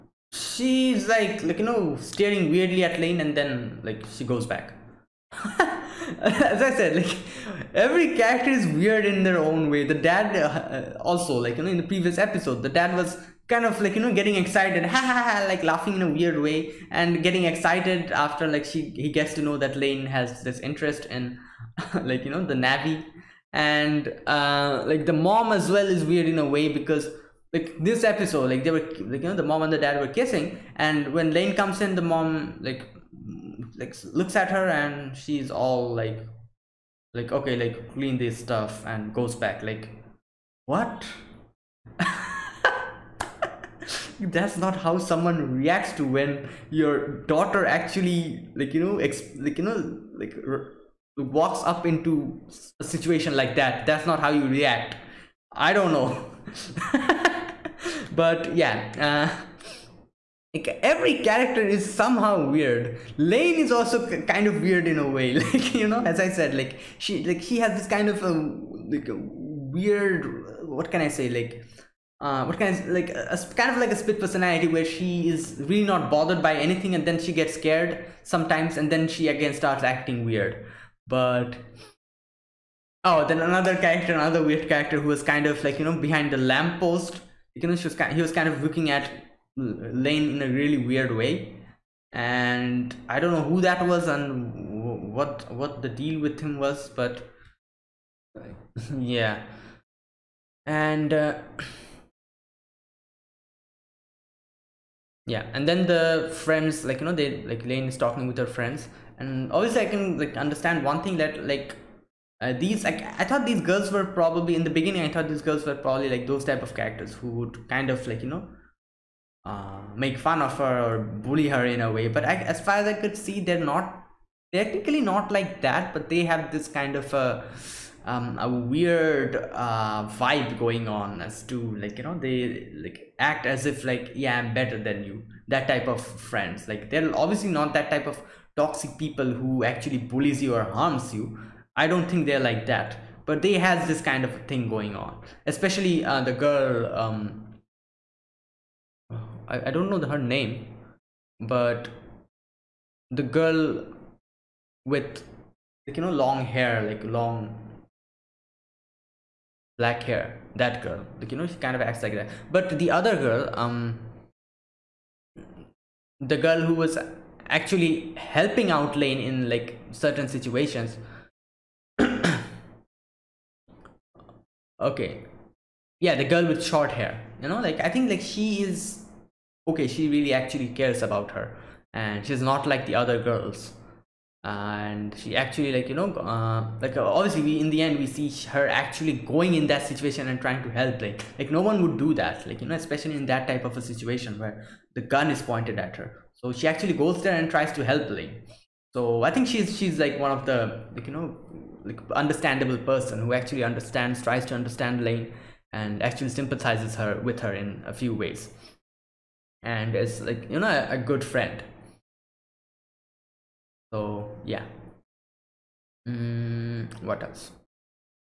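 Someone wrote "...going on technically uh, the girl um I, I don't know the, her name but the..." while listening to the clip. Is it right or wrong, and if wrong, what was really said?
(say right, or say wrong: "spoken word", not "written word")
wrong: "especially", not "technically".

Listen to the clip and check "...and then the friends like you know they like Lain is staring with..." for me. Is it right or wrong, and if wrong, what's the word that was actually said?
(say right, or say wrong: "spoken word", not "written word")
wrong: "talking", not "staring".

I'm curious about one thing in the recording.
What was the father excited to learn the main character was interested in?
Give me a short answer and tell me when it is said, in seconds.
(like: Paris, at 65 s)
the navi, at 22 s.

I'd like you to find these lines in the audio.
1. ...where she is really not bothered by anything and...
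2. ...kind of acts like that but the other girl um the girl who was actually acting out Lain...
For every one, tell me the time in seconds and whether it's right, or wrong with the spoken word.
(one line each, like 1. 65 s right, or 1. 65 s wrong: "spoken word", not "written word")
1. 74 s right
2. 161 s wrong: "helping", not "acting".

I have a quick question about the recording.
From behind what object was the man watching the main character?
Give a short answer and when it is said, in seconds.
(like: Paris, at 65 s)
lamppost, at 86 s.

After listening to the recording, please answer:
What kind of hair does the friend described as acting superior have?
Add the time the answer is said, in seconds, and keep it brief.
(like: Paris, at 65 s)
long black hair, at 157 s.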